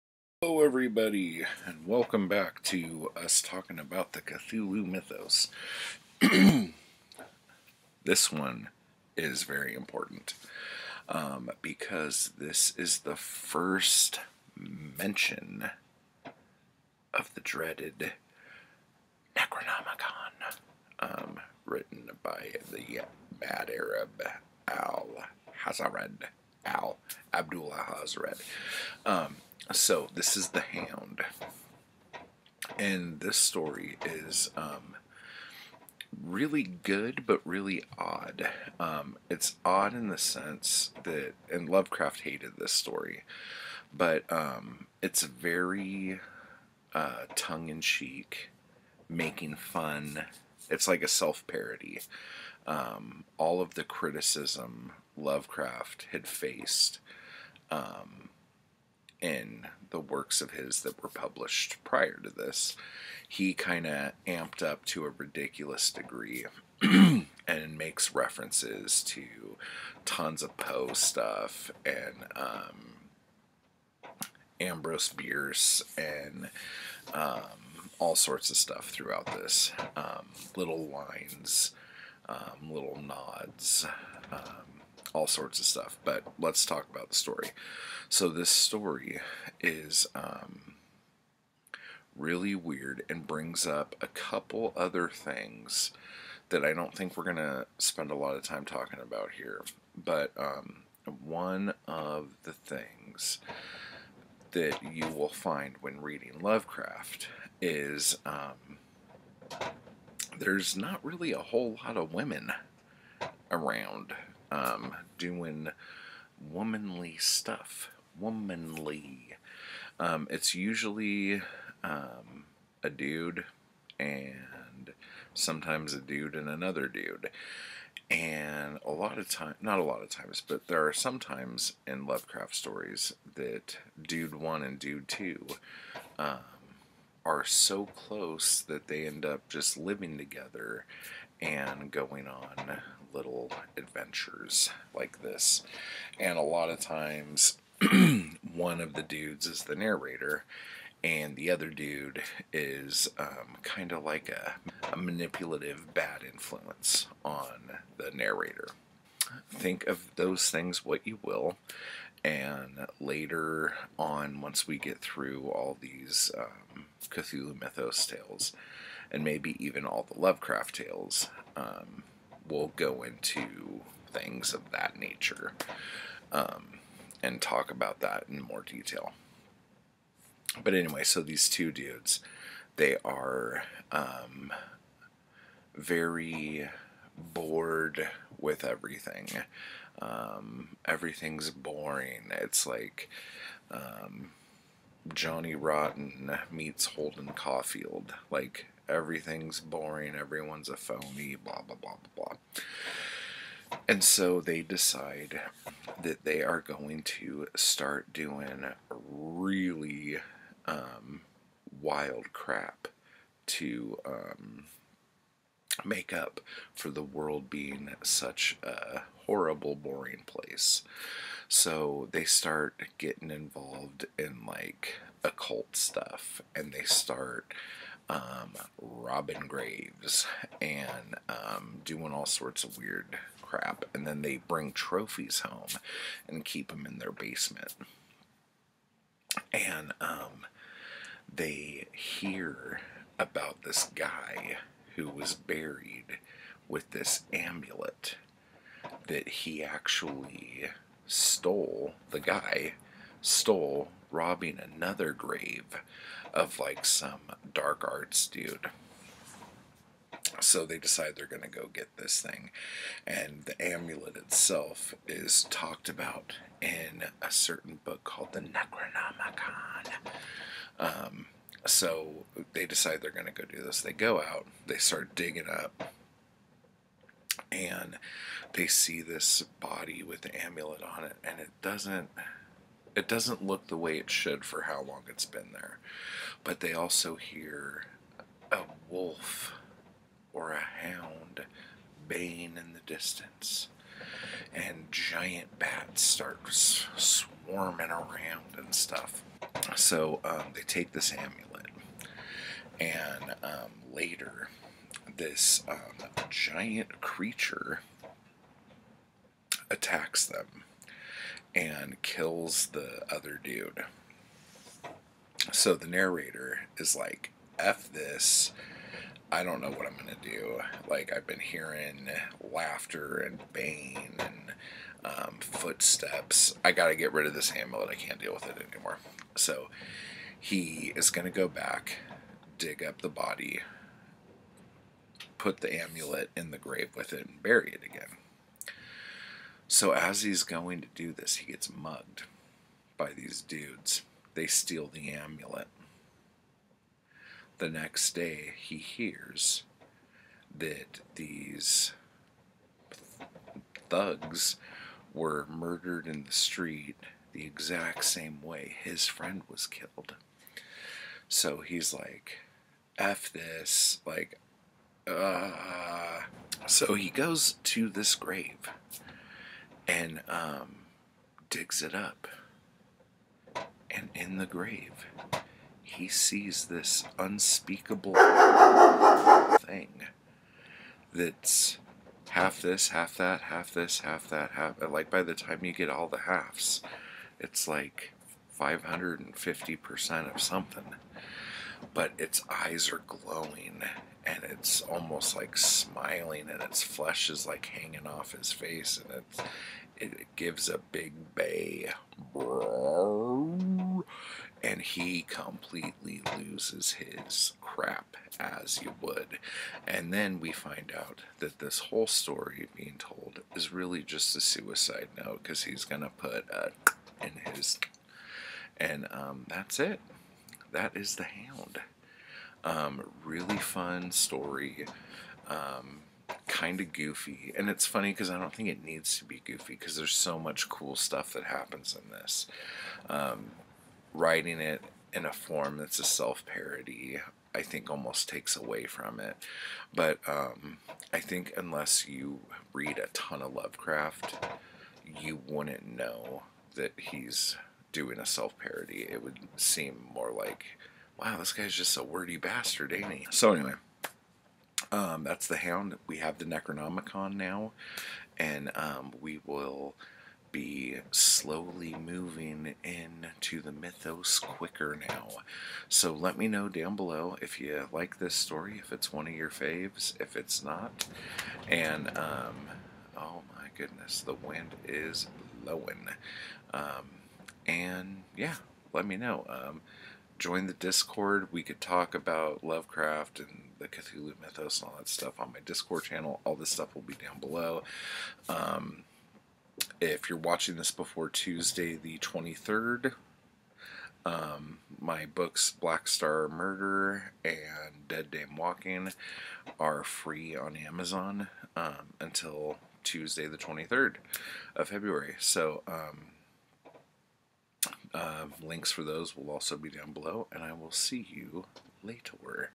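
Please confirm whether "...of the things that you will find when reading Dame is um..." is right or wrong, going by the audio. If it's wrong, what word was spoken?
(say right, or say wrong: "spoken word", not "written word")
wrong: "Lovecraft", not "Dame".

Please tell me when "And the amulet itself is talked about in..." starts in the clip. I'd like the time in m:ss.
4:23.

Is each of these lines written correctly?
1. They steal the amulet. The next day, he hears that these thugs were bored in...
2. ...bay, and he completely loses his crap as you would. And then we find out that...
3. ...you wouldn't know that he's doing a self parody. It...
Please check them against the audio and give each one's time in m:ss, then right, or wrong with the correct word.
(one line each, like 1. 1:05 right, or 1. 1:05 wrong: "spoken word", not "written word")
1. 5:44 wrong: "murdered", not "bored"
2. 6:41 right
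3. 7:25 right.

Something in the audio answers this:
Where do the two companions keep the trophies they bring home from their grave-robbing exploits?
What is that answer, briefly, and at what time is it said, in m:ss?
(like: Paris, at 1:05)
their basement, at 3:56.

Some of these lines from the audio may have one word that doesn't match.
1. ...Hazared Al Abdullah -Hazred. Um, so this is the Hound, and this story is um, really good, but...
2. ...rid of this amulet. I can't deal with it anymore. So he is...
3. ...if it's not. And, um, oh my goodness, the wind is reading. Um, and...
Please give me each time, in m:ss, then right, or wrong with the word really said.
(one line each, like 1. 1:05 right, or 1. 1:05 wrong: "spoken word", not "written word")
1. 0:25 right
2. 5:27 right
3. 7:50 wrong: "blowing", not "reading".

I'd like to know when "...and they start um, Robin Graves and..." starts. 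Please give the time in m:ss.
3:46.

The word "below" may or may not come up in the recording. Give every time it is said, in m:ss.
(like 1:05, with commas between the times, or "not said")
7:46, 8:07, 8:30.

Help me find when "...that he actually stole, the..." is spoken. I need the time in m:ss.
4:09.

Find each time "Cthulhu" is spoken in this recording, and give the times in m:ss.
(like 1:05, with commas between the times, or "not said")
0:04, 2:47, 8:03.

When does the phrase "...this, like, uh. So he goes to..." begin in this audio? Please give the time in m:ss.
6:03.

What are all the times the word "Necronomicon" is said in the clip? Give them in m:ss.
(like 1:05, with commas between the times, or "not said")
0:19, 4:28, 7:36.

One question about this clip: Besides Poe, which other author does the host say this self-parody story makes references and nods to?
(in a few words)
Ambrose Bierce.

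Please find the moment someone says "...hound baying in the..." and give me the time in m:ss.
4:50.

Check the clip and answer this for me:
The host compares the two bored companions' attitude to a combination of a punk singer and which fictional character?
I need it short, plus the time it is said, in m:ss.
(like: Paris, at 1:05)
Holden Caulfield, at 3:16.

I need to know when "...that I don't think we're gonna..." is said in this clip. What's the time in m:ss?
1:36.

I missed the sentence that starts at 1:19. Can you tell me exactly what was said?
Um, little lines, um, little nods, um, all sorts of stuff.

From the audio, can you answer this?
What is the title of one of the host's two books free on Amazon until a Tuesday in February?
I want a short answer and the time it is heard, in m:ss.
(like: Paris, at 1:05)
Black Star Murder, at 8:15.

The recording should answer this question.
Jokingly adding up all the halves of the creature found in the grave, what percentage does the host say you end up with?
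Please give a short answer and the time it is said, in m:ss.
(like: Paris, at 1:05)
550%, at 6:28.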